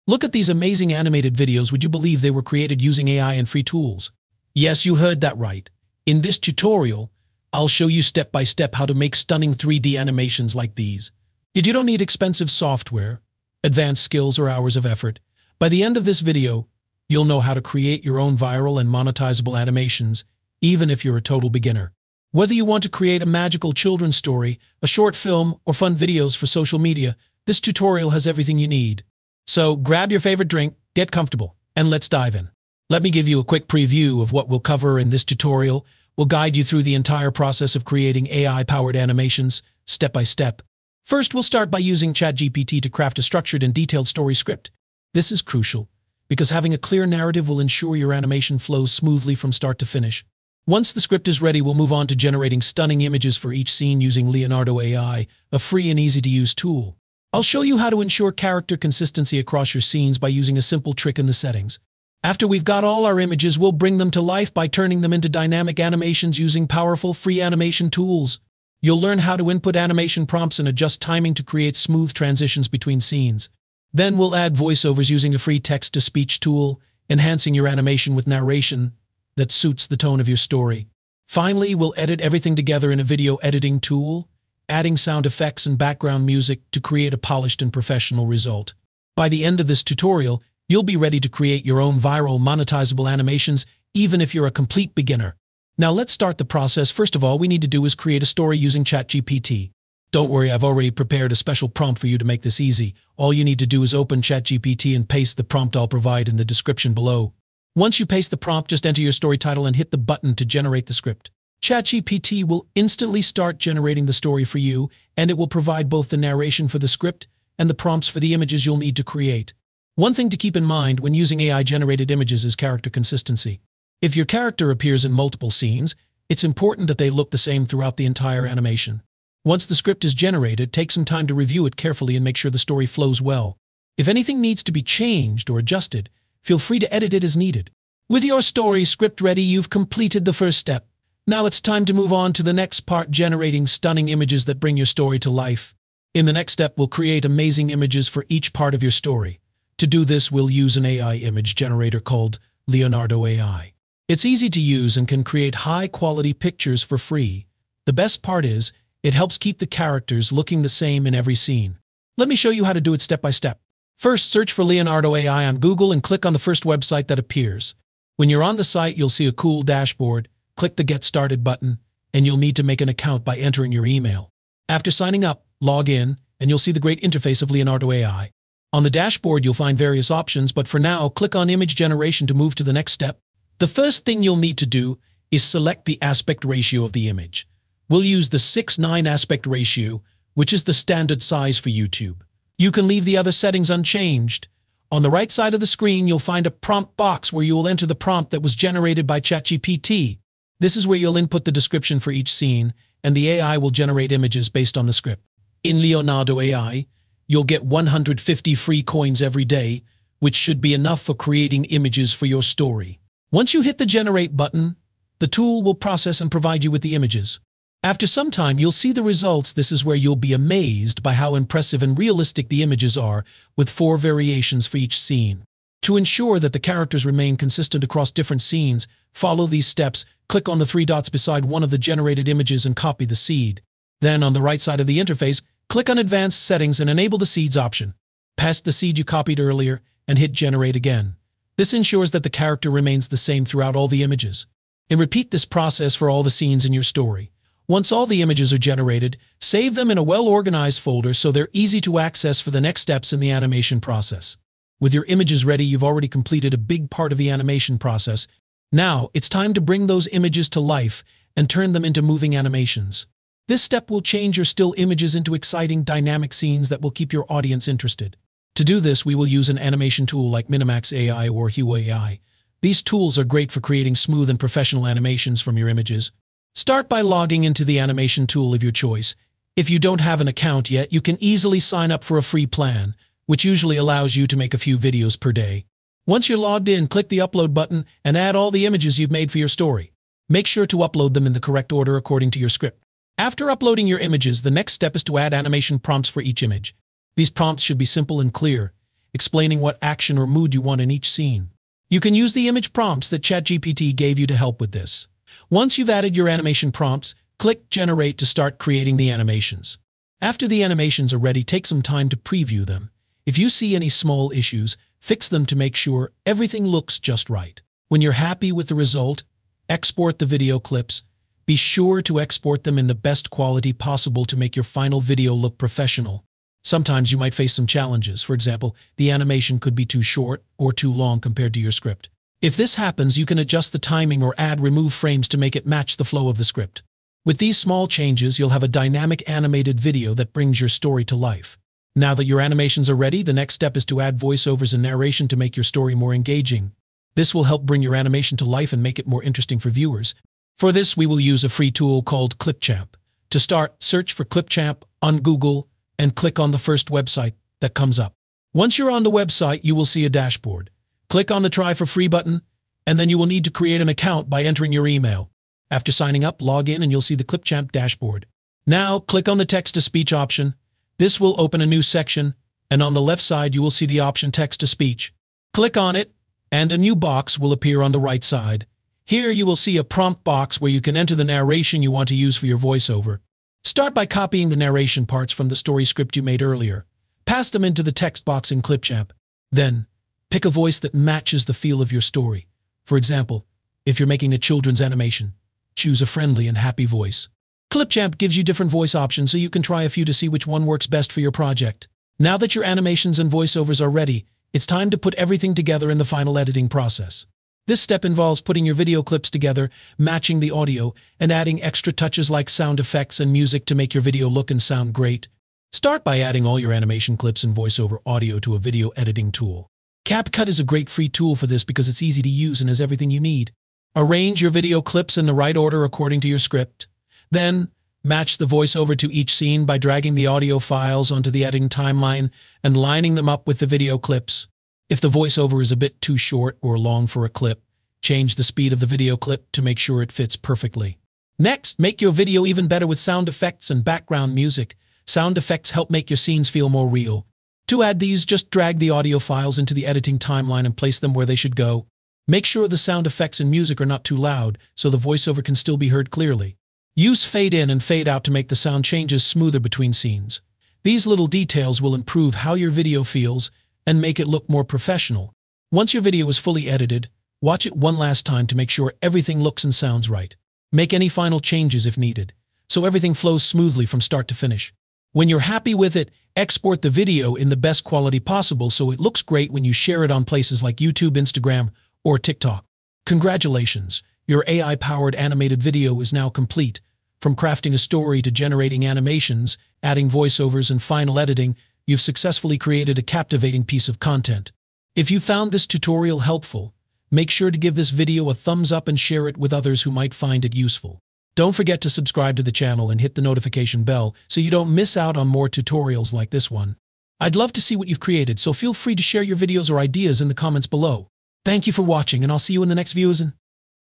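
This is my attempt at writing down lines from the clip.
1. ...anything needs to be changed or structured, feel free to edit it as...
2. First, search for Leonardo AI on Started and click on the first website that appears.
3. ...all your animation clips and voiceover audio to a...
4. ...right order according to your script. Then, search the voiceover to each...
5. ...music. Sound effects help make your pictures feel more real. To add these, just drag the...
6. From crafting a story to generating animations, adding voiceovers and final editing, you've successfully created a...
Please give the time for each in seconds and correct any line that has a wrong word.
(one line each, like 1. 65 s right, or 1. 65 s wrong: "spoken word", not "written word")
1. 134 s wrong: "adjusted", not "structured"
2. 163 s wrong: "Google", not "Started"
3. 416 s right
4. 425 s wrong: "match", not "search"
5. 444 s wrong: "scenes", not "pictures"
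6. 487 s right.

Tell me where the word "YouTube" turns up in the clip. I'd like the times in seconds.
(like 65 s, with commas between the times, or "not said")
191 s, 480 s.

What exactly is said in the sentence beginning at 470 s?
Make any final changes if needed, so everything flows smoothly from start to finish.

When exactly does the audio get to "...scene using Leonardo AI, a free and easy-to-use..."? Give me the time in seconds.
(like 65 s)
53 s.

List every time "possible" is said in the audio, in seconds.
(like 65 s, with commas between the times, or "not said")
323 s, 478 s.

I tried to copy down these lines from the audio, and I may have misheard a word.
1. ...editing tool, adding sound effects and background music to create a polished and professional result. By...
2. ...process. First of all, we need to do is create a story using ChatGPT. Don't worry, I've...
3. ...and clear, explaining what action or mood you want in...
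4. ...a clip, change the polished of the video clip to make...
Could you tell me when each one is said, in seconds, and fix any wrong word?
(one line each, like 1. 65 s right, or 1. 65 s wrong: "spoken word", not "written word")
1. 83 s right
2. 96 s right
3. 298 s right
4. 437 s wrong: "speed", not "polished".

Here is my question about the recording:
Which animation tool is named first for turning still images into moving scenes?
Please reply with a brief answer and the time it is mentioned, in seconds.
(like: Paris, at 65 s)
Minimax AI, at 270 s.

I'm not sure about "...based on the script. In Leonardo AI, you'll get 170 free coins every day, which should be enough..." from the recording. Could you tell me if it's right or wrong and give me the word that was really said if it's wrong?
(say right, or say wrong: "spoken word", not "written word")
wrong: "150", not "170".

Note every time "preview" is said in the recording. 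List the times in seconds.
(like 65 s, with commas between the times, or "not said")
33 s, 312 s.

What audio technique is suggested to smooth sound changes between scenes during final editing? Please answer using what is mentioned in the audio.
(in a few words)
Fade in and fade out.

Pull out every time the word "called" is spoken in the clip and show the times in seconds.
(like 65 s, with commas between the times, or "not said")
151 s, 352 s.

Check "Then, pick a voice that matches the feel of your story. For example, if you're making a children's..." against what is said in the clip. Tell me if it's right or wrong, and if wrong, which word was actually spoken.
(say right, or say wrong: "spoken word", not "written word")
right.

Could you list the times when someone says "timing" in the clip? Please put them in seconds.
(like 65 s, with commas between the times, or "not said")
71 s, 333 s.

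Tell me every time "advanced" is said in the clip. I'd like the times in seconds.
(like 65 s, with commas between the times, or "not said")
13 s, 235 s.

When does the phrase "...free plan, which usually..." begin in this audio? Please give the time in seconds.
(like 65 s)
282 s.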